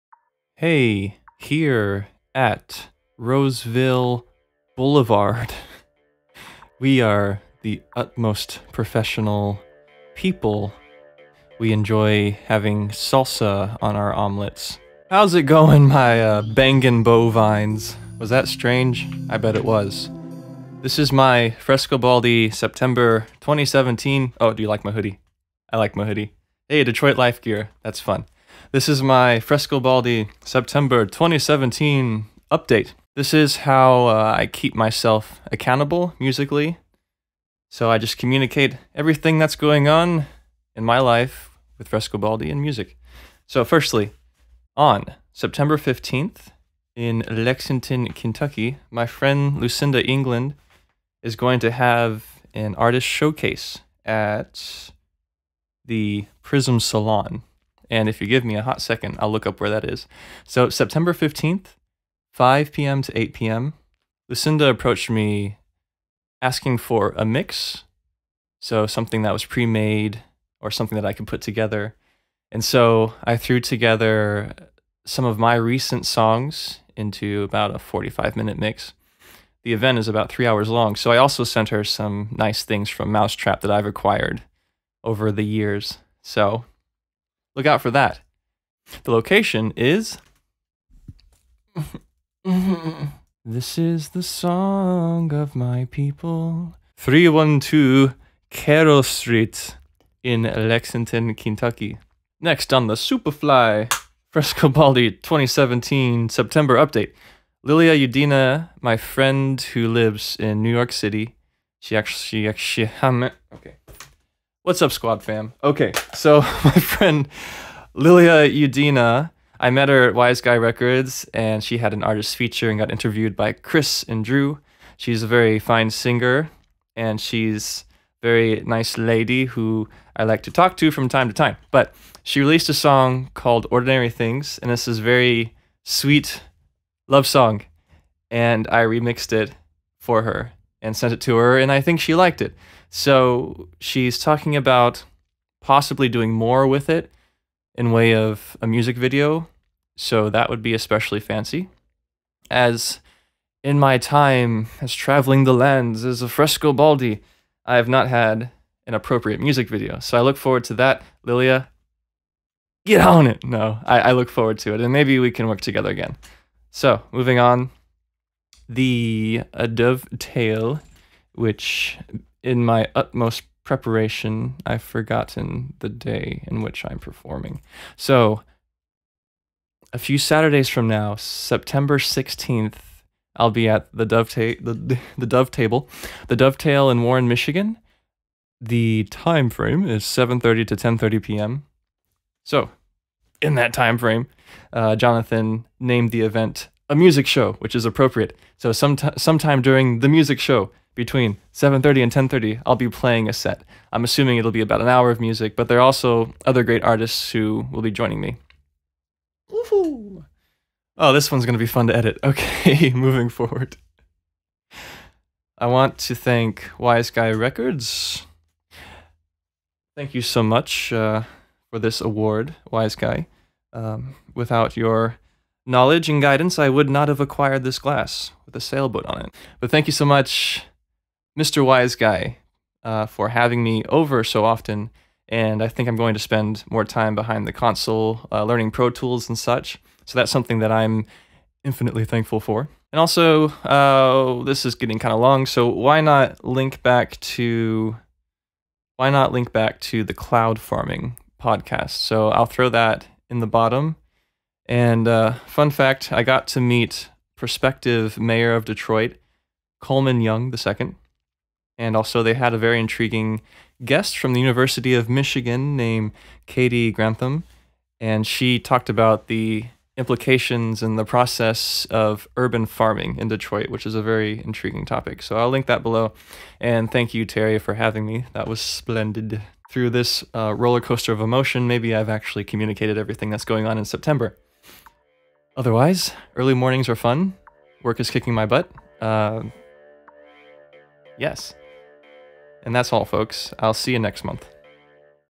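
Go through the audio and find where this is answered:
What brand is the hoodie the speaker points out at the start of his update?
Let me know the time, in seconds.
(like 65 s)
26 s.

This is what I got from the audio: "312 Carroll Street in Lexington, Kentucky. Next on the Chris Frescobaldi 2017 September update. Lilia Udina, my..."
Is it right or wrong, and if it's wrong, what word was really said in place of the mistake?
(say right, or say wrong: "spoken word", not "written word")
wrong: "Superfly", not "Chris".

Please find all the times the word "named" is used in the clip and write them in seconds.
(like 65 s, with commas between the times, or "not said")
195 s, 265 s.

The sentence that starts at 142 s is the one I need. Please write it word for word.
So she's talking about possibly doing more with it in way of a music video.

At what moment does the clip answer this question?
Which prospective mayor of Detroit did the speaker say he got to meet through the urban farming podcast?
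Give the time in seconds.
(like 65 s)
259 s.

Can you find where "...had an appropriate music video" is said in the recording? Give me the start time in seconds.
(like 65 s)
158 s.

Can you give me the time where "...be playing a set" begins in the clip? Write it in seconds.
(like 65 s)
202 s.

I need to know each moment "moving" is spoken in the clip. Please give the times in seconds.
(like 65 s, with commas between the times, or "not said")
167 s, 212 s.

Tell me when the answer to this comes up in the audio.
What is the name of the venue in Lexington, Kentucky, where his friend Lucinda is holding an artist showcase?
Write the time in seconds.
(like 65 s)
56 s.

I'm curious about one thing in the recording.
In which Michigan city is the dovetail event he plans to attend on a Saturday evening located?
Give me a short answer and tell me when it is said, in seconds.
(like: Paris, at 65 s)
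Warren, at 187 s.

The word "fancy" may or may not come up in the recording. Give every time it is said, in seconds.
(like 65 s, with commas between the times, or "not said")
151 s.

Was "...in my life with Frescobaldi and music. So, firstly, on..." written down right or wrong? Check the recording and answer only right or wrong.
right.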